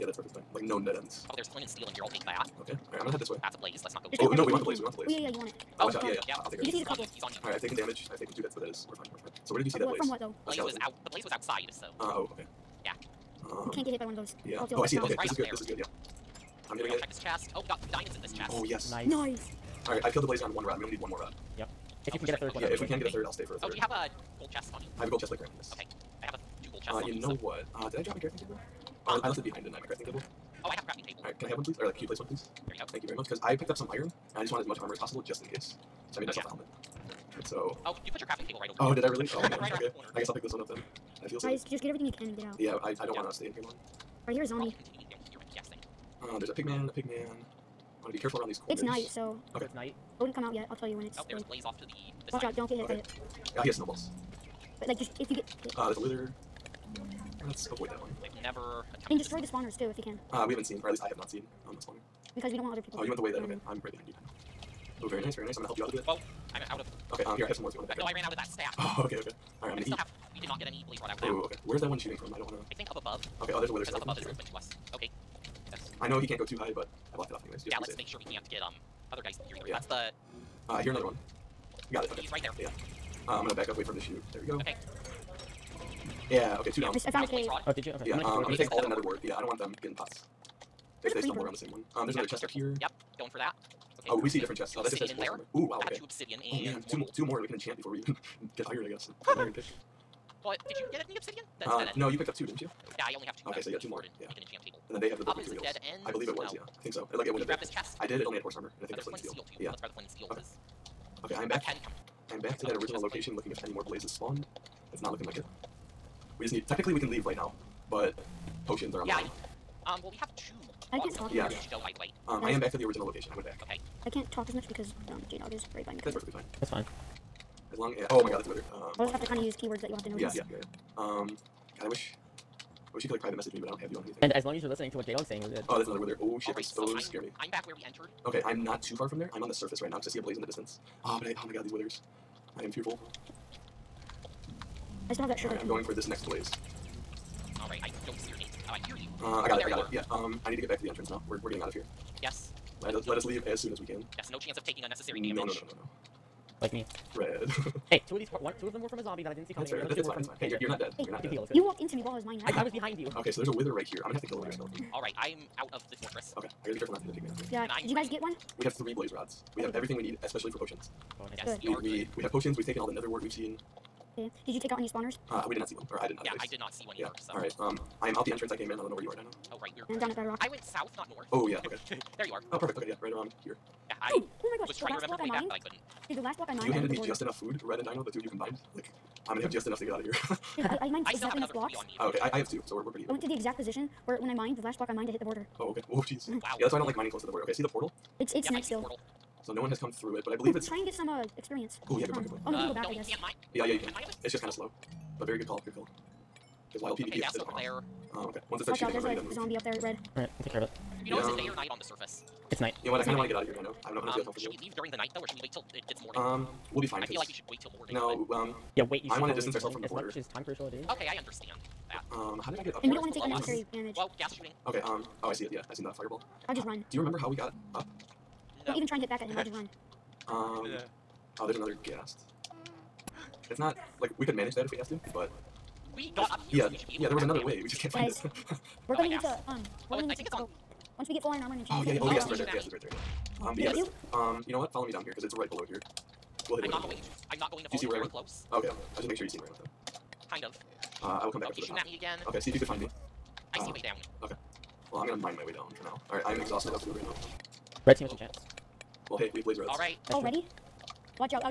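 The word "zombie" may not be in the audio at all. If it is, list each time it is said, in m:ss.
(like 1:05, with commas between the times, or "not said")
0:44, 2:39, 3:29.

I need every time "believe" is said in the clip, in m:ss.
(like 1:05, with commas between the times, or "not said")
1:46, 3:20.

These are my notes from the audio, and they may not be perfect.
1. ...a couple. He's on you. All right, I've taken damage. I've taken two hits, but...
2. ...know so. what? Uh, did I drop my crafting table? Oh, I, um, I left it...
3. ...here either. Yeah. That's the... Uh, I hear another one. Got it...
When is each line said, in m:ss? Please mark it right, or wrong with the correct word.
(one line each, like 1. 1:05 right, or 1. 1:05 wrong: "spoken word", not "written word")
1. 0:06 right
2. 0:27 right
3. 1:19 right.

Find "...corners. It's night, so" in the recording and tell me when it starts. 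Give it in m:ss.
0:48.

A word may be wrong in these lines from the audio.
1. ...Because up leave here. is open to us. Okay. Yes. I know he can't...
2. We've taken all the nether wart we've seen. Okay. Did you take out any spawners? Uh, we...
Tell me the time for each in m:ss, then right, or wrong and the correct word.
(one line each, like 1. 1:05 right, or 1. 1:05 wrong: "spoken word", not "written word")
1. 1:13 wrong: "above", not "leave"
2. 2:52 right.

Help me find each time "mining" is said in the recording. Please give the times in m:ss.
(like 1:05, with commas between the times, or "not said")
2:42, 3:16.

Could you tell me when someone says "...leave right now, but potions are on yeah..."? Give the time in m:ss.
1:57.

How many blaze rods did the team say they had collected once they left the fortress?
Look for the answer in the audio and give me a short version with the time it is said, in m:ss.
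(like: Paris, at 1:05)
3, at 2:48.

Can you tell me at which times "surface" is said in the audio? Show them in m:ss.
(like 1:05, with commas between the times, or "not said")
2:19, 3:31.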